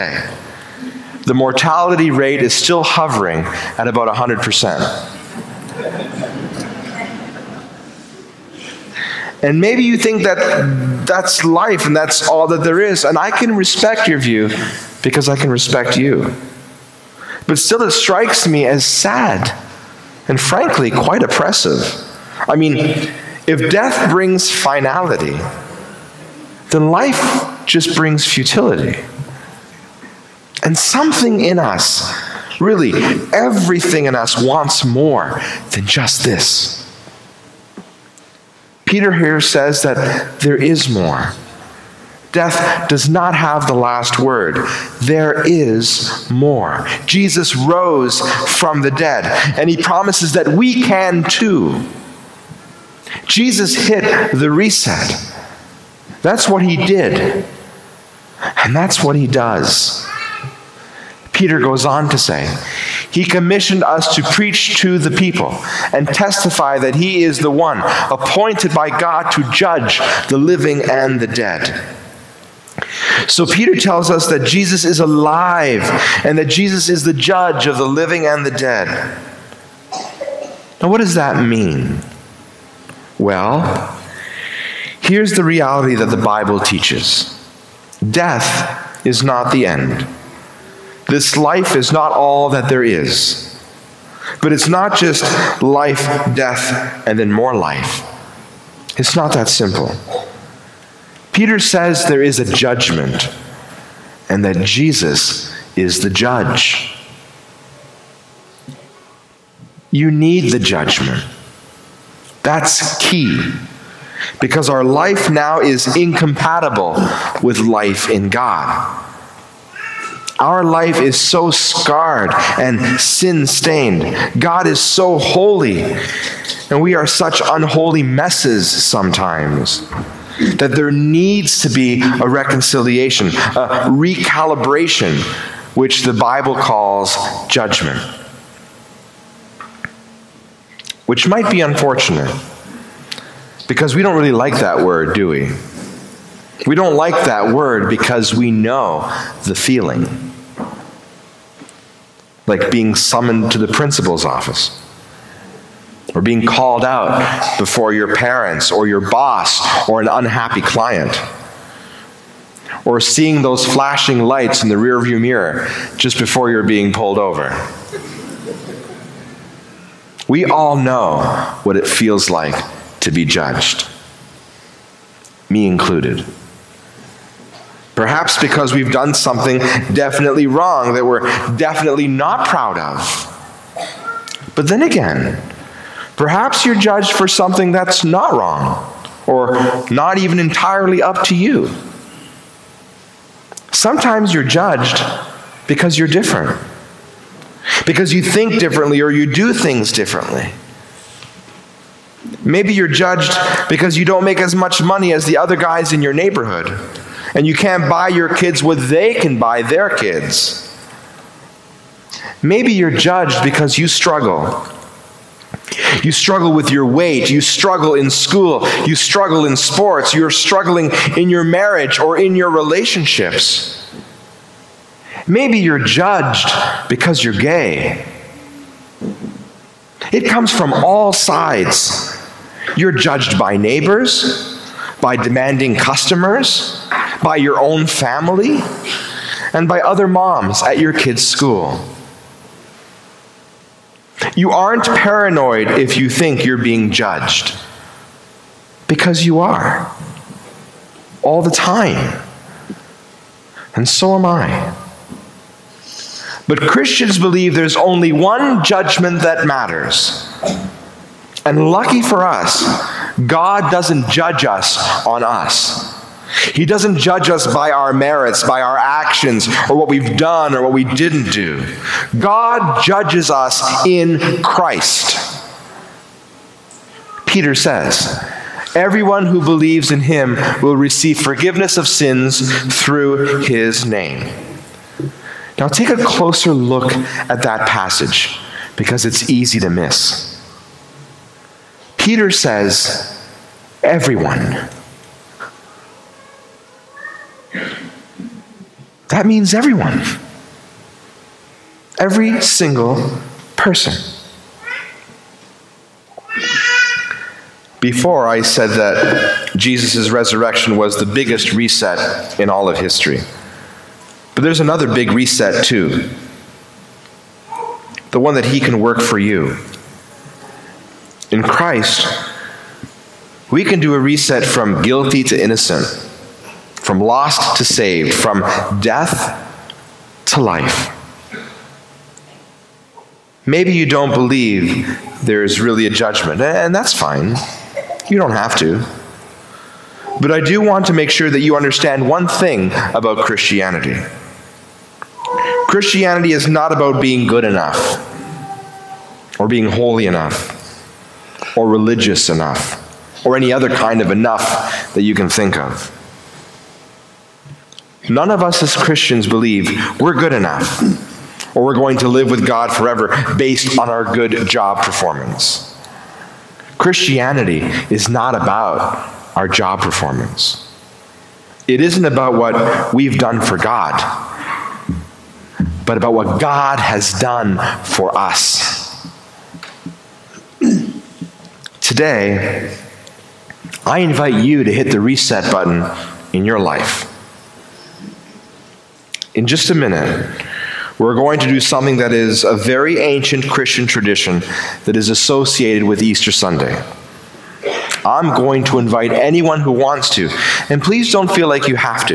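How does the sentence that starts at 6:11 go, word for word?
It isn't about what we've done for God, but about what God has done for us.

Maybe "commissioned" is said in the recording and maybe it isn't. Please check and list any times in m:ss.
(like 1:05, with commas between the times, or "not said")
1:03.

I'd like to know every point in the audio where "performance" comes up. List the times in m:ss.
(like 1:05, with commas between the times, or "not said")
6:04, 6:09.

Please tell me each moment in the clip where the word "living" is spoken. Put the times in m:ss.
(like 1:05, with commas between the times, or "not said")
1:10, 1:17.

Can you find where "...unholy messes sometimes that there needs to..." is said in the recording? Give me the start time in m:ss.
2:07.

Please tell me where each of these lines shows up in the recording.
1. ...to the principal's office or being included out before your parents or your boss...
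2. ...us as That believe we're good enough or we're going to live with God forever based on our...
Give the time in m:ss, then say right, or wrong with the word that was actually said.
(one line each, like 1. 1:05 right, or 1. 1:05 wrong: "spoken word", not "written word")
1. 2:33 wrong: "called", not "included"
2. 5:58 wrong: "Christians", not "That".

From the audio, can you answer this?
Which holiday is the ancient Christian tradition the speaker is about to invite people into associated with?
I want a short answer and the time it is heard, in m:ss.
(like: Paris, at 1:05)
Easter Sunday, at 6:36.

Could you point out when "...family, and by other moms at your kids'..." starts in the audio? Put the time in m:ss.
3:57.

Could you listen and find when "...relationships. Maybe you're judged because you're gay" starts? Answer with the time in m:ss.
3:42.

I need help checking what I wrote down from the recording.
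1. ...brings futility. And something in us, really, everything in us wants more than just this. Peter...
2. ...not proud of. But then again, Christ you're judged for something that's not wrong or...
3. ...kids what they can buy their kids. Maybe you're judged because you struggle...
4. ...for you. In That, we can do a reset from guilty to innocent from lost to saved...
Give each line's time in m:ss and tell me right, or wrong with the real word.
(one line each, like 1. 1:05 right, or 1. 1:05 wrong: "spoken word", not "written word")
1. 0:27 right
2. 3:02 wrong: "Perhaps", not "Christ"
3. 3:28 right
4. 5:19 wrong: "Christ", not "That".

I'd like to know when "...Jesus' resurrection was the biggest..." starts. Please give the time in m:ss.
5:09.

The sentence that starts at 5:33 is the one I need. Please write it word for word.
Maybe you don't believe there is really a judgment, and that's fine.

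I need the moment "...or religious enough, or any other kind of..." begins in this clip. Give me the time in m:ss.
5:51.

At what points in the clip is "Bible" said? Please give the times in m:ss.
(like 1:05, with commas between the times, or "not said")
1:26, 2:16.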